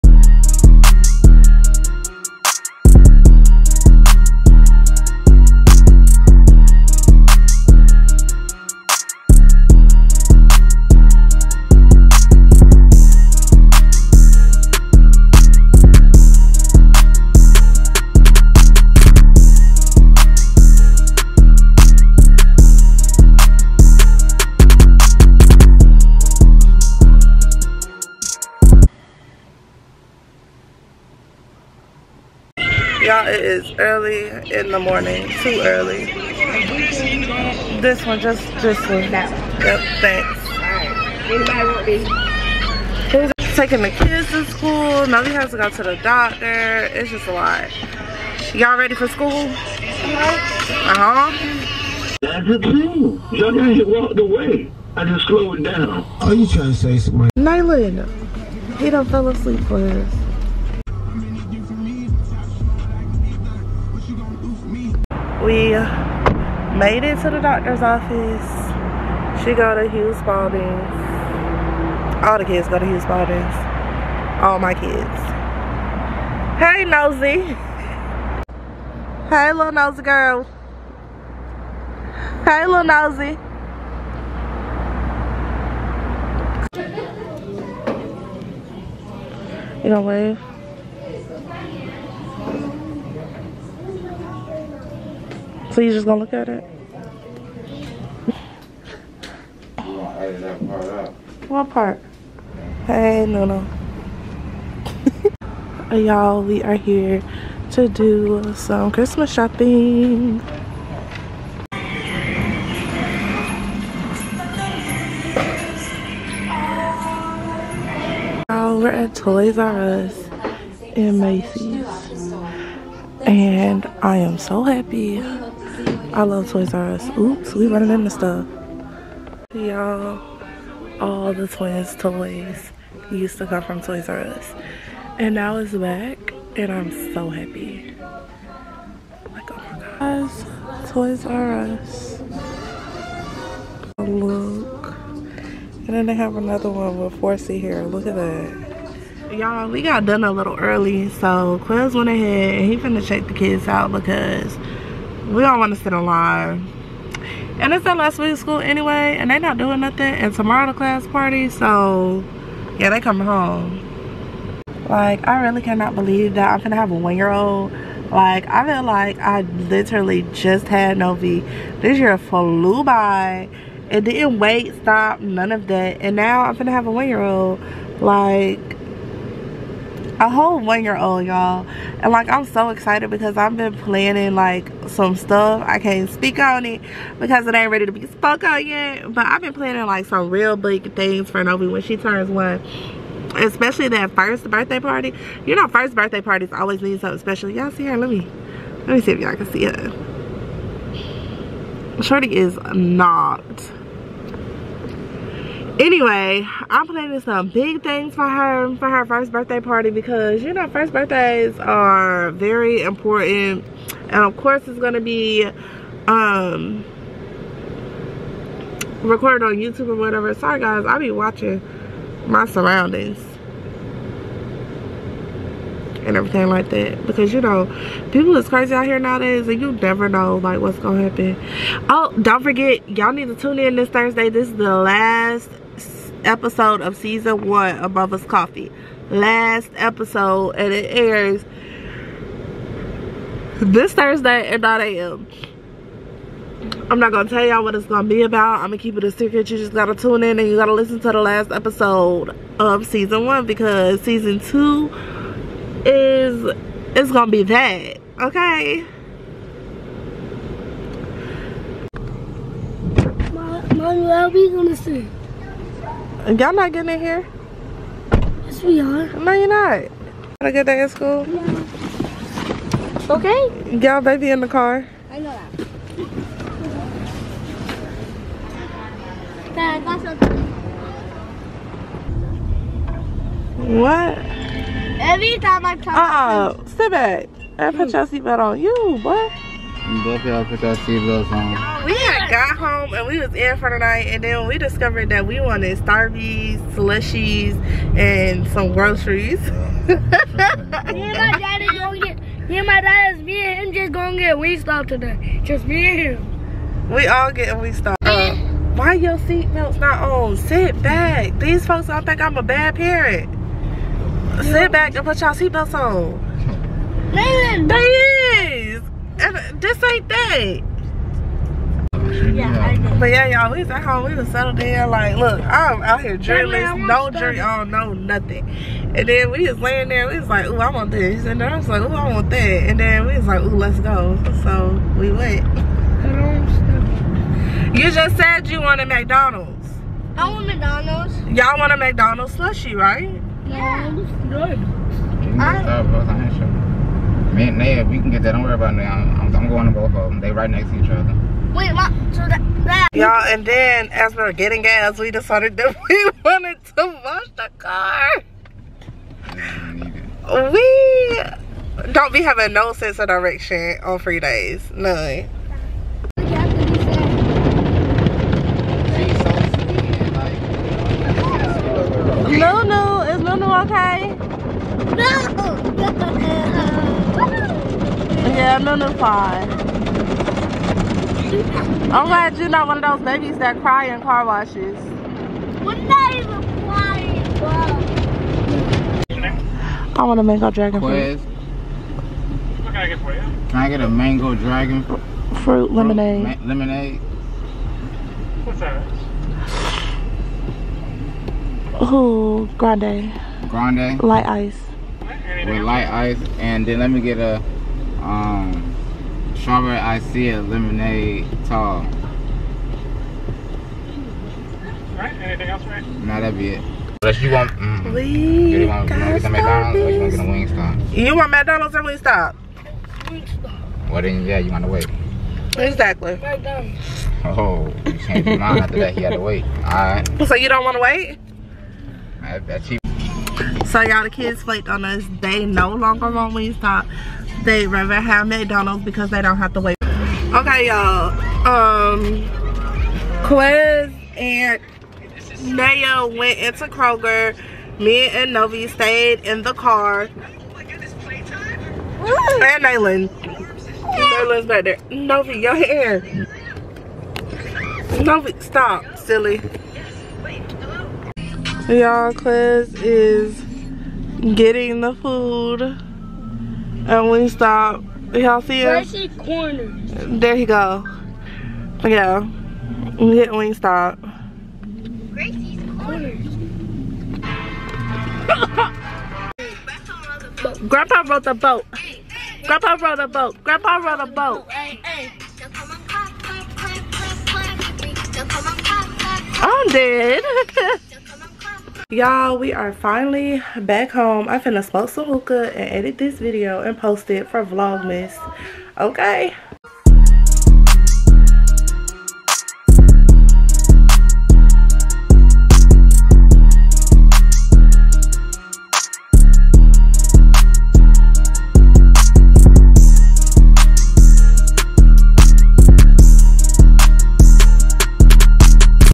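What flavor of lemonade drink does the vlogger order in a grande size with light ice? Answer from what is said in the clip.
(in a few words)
Mango dragon fruit.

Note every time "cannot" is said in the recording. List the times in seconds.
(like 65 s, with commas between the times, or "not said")
165 s.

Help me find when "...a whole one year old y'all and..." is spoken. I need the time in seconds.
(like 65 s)
180 s.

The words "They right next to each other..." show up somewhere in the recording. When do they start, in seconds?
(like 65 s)
350 s.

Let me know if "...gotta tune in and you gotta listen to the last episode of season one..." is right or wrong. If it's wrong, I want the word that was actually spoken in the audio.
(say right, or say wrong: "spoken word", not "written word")
right.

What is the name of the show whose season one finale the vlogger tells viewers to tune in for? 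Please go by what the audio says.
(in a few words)
Mother's Coffee.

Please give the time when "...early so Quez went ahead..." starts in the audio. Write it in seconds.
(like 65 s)
150 s.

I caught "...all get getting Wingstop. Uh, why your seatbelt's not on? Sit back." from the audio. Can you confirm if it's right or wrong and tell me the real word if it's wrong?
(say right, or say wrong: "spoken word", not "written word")
right.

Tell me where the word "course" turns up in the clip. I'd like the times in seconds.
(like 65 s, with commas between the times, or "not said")
214 s.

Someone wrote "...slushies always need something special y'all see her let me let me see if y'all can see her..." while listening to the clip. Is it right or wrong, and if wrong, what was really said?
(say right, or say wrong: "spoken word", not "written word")
wrong: "parties", not "slushies".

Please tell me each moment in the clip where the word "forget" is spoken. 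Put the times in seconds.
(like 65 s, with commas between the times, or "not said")
232 s.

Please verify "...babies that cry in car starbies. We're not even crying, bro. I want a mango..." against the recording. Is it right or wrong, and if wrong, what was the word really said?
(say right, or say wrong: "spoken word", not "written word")
wrong: "washes", not "starbies".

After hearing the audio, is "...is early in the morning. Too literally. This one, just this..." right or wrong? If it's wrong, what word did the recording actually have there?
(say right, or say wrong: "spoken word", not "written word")
wrong: "early", not "literally".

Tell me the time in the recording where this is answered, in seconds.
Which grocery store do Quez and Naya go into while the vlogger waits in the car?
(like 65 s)
446 s.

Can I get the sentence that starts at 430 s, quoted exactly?
So you don't want to wait?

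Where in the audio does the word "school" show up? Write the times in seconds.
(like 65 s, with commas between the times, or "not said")
44 s, 49 s, 158 s, 270 s.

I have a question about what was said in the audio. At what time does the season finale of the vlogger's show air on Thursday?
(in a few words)
9 a.m.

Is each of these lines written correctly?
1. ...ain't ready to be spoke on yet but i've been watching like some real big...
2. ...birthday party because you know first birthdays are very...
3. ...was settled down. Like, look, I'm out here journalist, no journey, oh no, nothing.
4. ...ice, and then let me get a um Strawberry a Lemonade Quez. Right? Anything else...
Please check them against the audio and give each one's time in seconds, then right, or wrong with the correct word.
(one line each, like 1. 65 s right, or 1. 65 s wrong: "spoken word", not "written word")
1. 187 s wrong: "planning", not "watching"
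2. 209 s right
3. 324 s right
4. 405 s wrong: "Tall", not "Quez".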